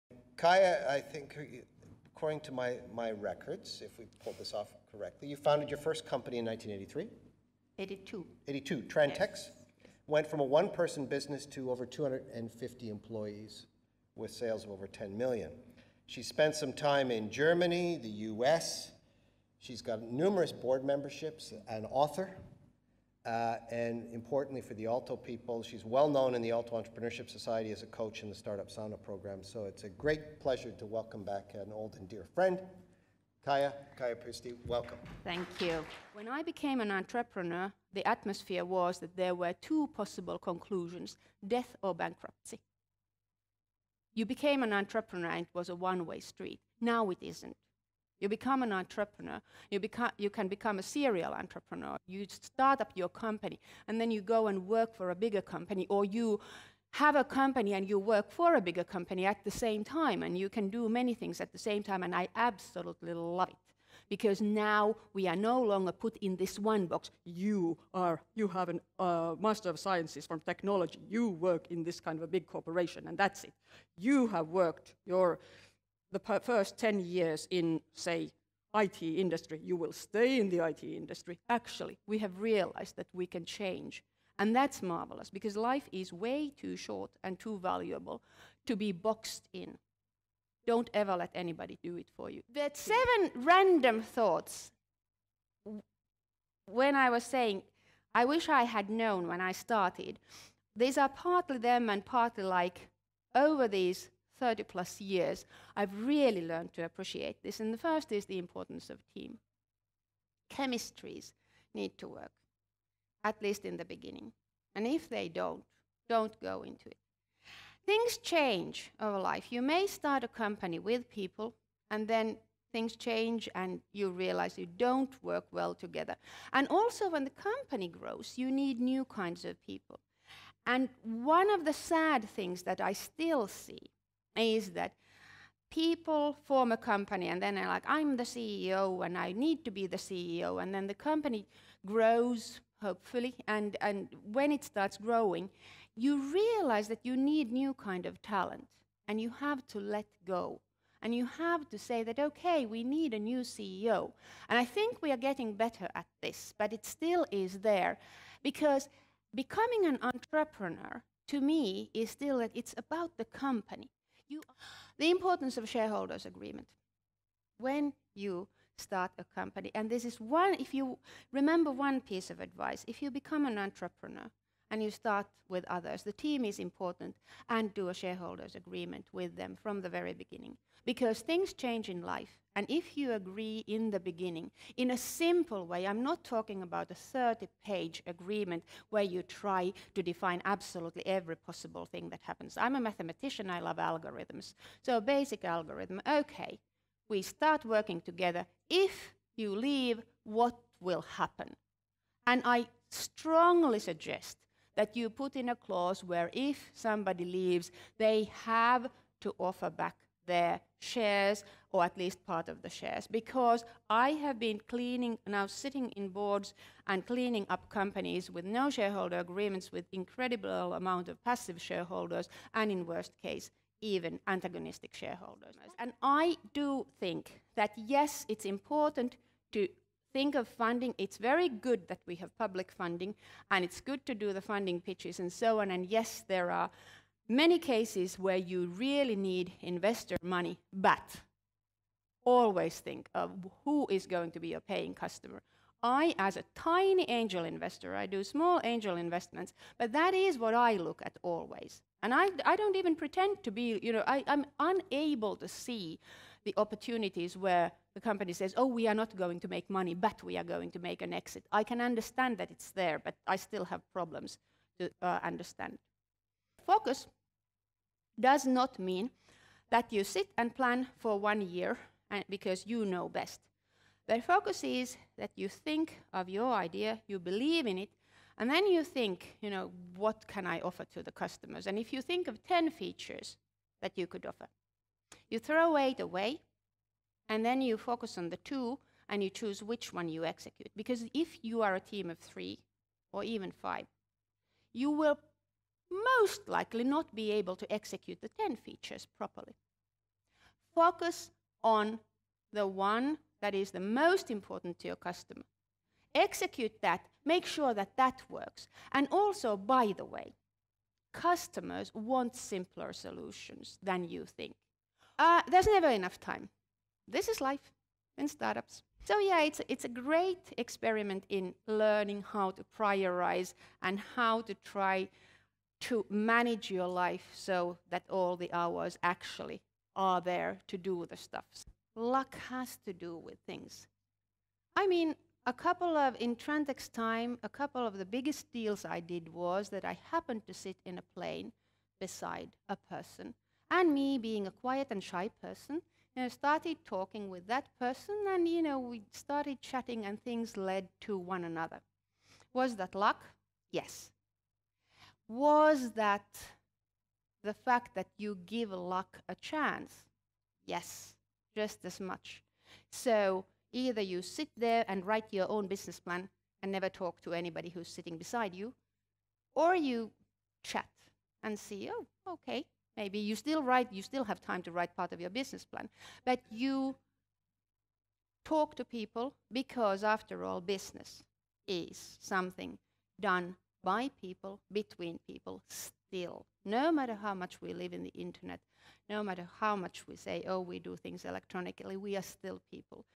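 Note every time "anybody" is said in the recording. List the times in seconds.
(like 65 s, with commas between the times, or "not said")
91 s, 367 s.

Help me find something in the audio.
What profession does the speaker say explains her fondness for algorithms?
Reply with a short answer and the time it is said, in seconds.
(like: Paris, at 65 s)
mathematician, at 192 s.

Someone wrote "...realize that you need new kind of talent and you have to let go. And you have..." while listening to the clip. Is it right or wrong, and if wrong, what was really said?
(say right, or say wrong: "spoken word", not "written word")
right.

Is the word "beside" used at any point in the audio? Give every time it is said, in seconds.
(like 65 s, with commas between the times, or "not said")
341 s, 368 s.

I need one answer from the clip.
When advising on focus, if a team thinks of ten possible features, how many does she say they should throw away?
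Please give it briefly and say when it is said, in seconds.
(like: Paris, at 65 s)
8, at 285 s.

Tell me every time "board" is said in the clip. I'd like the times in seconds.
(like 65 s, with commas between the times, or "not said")
20 s, 216 s.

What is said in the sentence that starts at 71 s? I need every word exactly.
You work in this kind of a big corporation, and that's it.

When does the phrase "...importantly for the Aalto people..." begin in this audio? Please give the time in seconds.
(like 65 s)
24 s.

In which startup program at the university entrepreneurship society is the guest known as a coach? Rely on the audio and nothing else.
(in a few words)
Startup Sauna.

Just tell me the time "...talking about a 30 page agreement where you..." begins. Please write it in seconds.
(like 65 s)
186 s.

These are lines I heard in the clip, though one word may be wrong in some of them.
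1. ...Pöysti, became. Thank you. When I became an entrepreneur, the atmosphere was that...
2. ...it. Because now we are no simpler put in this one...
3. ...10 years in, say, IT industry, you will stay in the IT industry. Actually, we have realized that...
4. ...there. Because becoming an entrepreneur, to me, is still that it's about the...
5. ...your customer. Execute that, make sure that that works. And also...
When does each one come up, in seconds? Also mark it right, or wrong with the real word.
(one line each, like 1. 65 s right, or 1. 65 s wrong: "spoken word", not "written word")
1. 34 s wrong: "welcome", not "became"
2. 63 s wrong: "longer", not "simpler"
3. 76 s right
4. 157 s right
5. 304 s right.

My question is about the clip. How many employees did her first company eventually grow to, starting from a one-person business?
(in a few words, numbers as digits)
over 250.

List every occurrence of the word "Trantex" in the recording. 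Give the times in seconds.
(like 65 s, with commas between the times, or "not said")
8 s, 336 s.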